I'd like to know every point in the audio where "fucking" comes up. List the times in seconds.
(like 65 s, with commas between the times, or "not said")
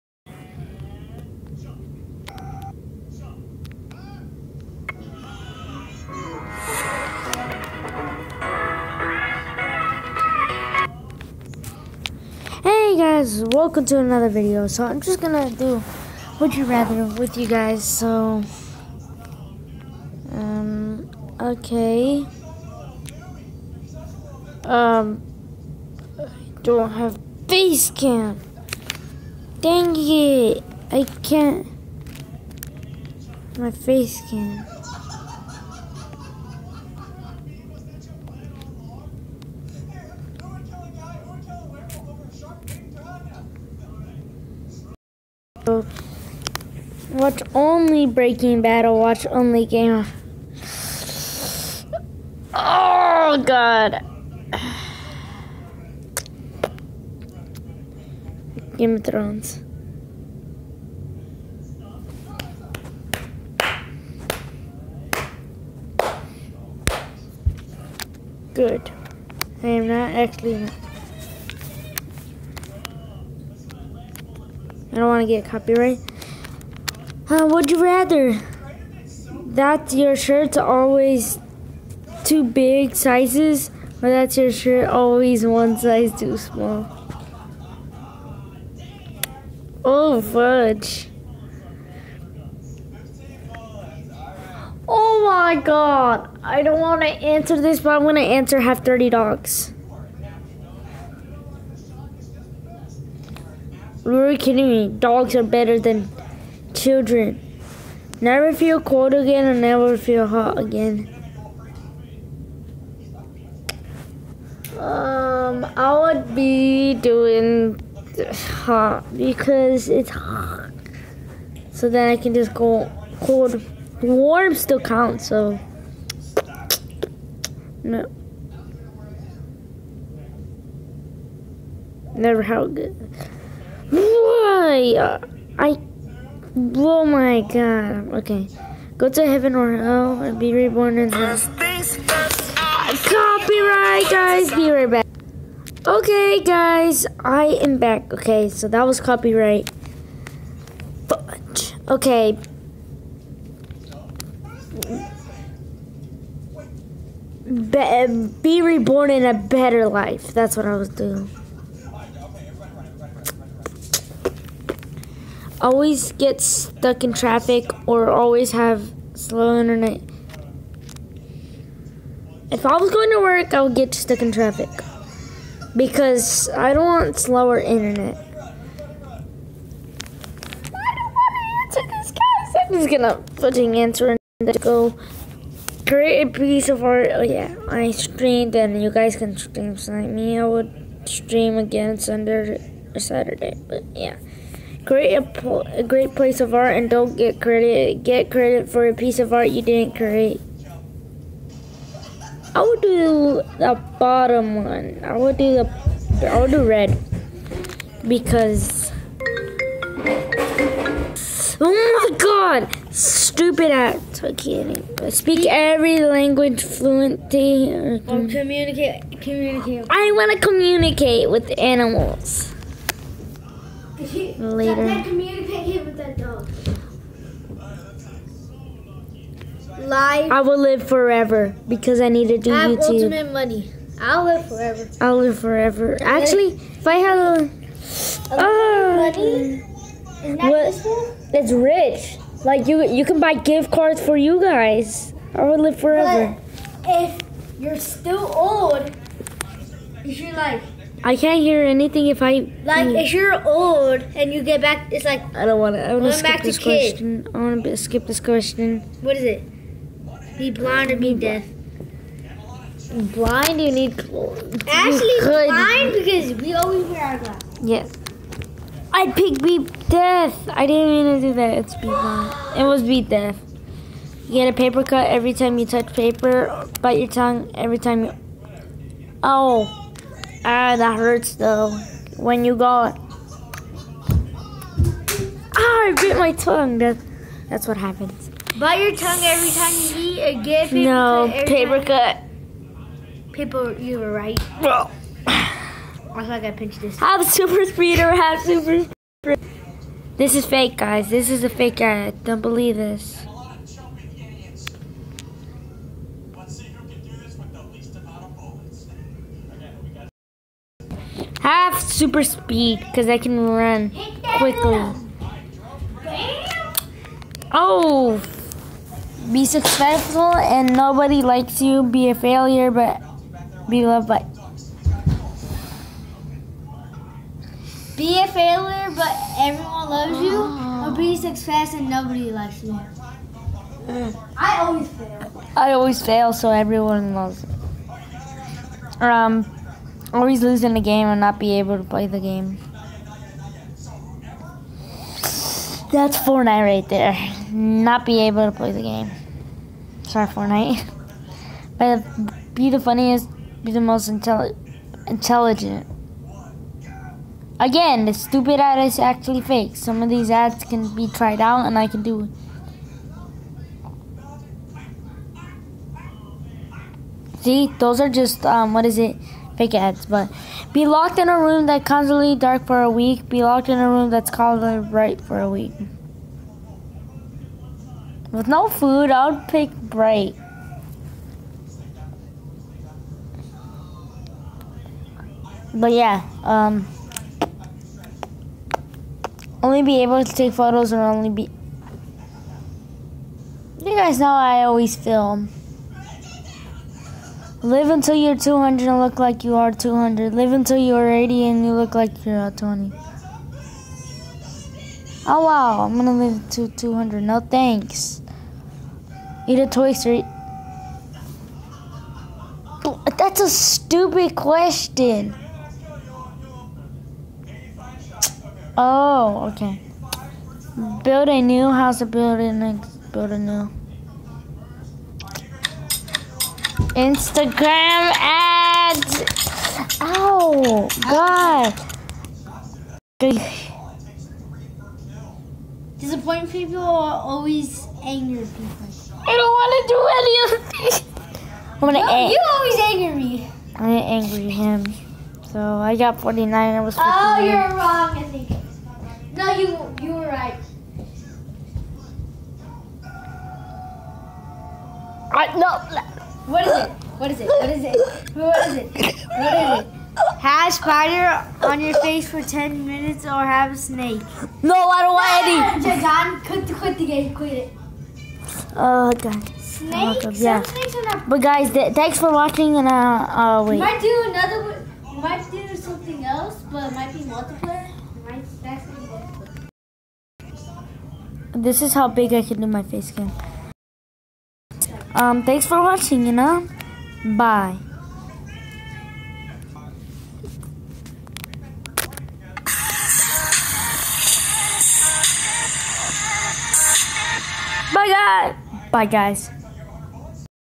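183 s.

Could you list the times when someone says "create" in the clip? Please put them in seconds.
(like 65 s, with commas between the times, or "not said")
185 s, 194 s, 199 s.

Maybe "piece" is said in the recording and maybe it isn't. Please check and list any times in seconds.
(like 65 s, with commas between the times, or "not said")
186 s, 198 s.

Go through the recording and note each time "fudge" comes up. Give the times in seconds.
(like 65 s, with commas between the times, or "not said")
90 s, 151 s.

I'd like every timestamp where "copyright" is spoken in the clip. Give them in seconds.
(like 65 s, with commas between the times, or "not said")
75 s, 143 s, 149 s.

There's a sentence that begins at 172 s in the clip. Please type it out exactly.
If I was going to work, I would get stuck in traffic because I don't want slower internet.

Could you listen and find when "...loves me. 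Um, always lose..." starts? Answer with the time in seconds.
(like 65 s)
337 s.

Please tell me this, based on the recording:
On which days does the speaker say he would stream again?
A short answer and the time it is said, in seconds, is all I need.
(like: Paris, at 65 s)
Sunday or Saturday, at 191 s.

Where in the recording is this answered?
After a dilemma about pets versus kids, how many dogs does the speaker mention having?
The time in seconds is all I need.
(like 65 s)
98 s.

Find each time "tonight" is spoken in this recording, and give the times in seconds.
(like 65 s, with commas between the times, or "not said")
189 s.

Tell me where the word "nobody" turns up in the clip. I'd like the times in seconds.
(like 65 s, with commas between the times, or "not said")
320 s, 331 s.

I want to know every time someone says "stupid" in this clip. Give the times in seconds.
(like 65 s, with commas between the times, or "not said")
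212 s, 358 s, 413 s.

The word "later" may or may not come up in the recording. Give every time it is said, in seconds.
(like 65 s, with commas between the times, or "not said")
224 s.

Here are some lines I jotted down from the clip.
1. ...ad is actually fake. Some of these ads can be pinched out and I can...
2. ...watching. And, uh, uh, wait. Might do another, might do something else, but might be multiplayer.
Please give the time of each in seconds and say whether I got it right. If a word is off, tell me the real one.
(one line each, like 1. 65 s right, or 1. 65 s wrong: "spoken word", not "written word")
1. 358 s wrong: "tried", not "pinched"
2. 472 s right.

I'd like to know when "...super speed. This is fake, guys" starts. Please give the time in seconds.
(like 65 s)
298 s.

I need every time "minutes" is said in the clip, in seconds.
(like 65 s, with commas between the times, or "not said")
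462 s.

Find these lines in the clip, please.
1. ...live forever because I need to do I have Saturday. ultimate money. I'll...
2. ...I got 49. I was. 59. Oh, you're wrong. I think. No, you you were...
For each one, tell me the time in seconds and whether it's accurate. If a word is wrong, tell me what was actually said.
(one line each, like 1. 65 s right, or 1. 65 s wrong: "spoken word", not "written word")
1. 230 s wrong: "YouTube", not "Saturday"
2. 445 s right.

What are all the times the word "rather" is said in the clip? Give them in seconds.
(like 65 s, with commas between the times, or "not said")
16 s, 77 s.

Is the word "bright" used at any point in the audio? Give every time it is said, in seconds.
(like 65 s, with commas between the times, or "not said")
374 s, 379 s.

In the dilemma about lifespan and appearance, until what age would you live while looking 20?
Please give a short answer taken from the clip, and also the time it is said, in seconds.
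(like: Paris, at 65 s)
80, at 401 s.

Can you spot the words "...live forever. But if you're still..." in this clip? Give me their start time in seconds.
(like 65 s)
245 s.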